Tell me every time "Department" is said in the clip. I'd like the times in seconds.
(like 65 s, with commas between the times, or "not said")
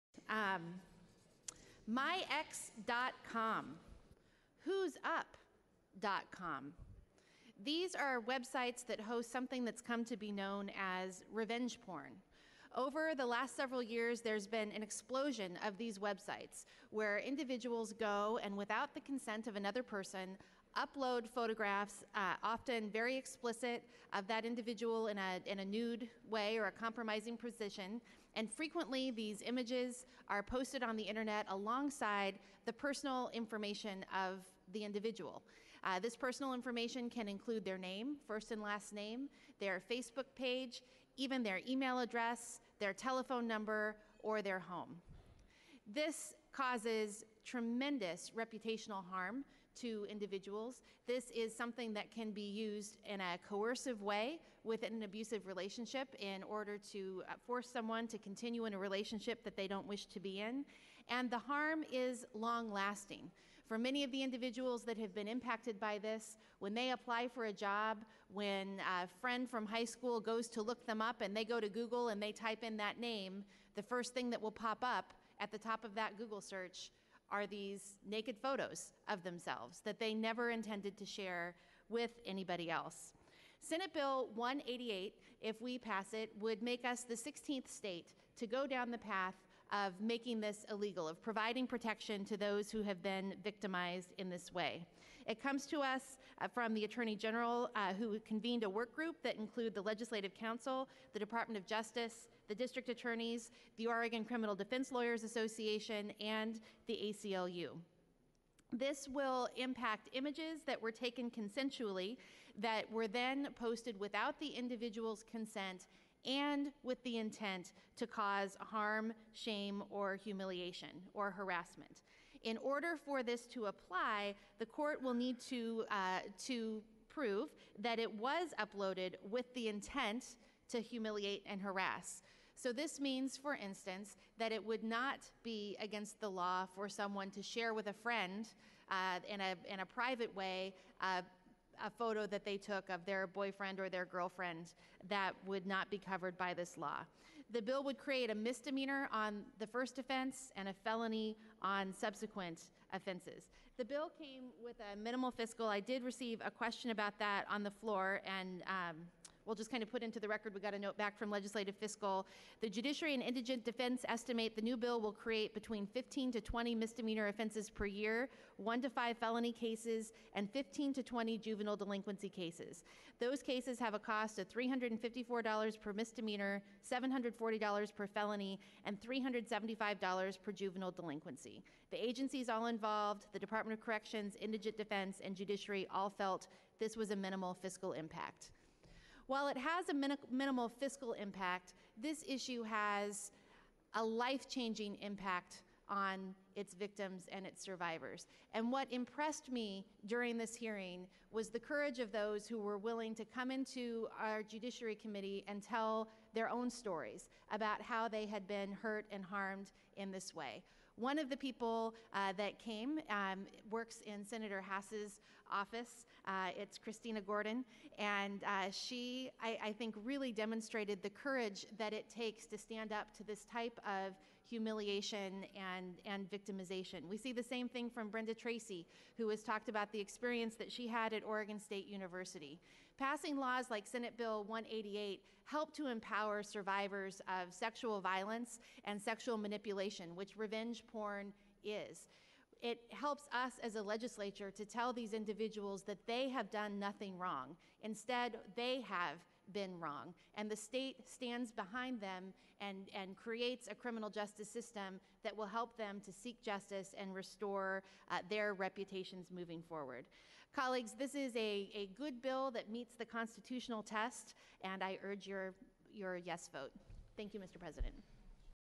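101 s, 183 s.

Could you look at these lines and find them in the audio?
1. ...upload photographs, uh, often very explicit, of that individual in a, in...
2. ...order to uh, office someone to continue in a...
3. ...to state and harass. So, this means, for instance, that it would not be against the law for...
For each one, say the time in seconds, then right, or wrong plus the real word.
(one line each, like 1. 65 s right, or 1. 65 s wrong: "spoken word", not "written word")
1. 20 s right
2. 56 s wrong: "force", not "office"
3. 130 s wrong: "humiliate", not "state".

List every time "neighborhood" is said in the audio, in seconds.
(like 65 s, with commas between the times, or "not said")
not said.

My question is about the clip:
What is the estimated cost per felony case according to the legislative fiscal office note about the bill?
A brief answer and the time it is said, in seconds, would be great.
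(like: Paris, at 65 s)
$740, at 176 s.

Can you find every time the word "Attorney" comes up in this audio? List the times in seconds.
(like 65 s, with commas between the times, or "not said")
96 s, 102 s.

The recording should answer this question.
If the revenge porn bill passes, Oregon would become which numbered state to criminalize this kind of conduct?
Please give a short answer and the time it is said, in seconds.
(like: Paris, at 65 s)
16th, at 87 s.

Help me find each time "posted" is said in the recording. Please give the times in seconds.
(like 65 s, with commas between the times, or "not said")
30 s, 113 s.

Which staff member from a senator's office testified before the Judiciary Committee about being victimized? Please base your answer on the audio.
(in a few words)
Christina Gordon.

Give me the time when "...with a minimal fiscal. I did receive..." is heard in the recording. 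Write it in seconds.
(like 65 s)
154 s.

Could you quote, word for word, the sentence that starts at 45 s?
This causes tremendous reputational harm to individuals.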